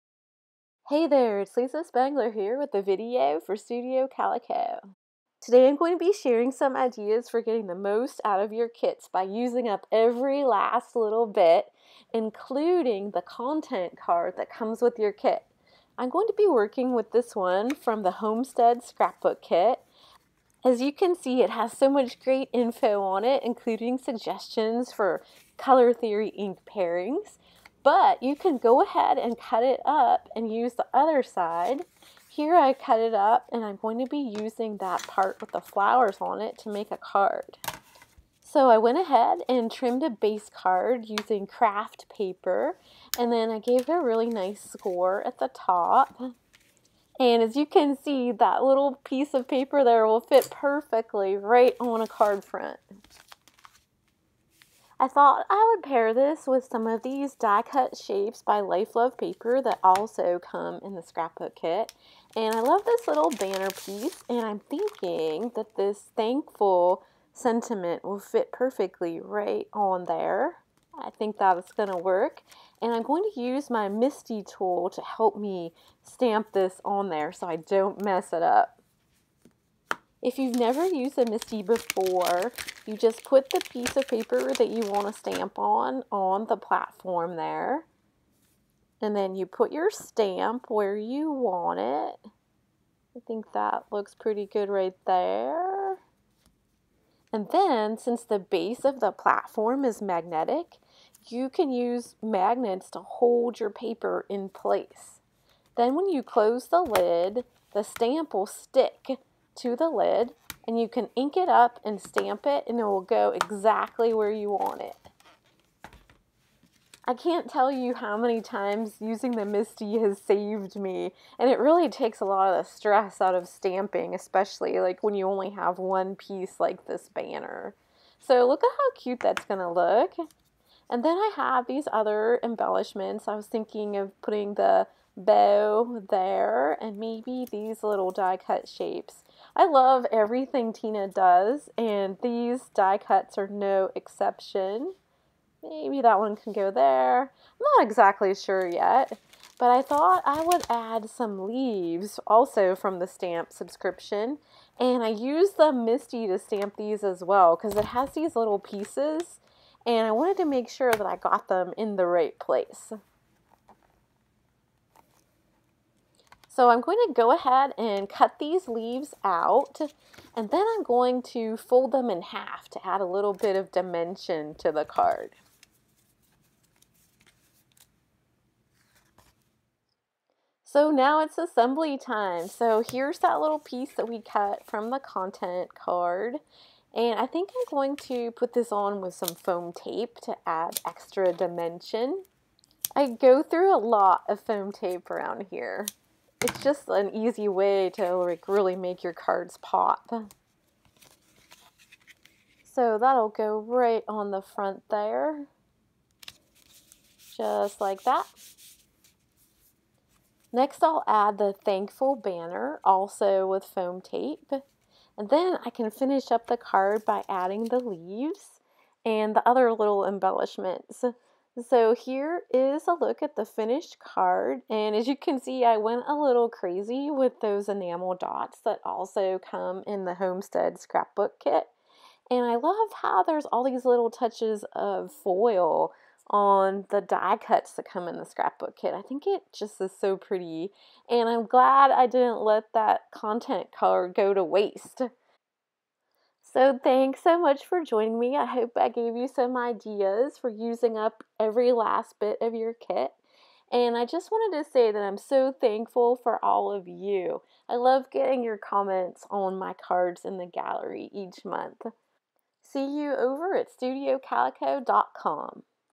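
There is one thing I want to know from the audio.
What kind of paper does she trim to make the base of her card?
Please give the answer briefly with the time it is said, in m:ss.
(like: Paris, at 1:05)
Craft paper, at 0:41.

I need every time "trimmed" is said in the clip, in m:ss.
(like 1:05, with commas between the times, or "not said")
0:39.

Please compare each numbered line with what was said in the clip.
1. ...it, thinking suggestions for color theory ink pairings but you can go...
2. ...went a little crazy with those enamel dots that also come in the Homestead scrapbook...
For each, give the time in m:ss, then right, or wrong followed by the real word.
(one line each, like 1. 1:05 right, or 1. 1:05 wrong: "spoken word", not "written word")
1. 0:23 wrong: "including", not "thinking"
2. 3:45 right.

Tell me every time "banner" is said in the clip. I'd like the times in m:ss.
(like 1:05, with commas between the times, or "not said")
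1:03, 2:07, 3:32.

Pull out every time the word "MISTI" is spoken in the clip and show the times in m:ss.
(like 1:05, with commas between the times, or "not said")
1:13, 1:21, 1:59, 2:35.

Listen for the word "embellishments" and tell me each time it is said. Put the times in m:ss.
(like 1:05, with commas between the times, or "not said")
2:12, 3:40.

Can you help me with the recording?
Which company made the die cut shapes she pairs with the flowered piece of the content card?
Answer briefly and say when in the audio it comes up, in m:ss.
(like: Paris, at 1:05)
Life Love Paper, at 0:58.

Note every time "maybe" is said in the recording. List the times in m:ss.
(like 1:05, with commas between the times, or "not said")
2:16, 2:25.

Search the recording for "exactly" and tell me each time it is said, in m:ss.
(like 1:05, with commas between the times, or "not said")
1:53, 2:27.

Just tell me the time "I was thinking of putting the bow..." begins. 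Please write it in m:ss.
2:13.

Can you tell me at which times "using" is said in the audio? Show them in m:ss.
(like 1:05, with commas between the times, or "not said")
0:09, 0:34, 0:41, 1:59, 4:10.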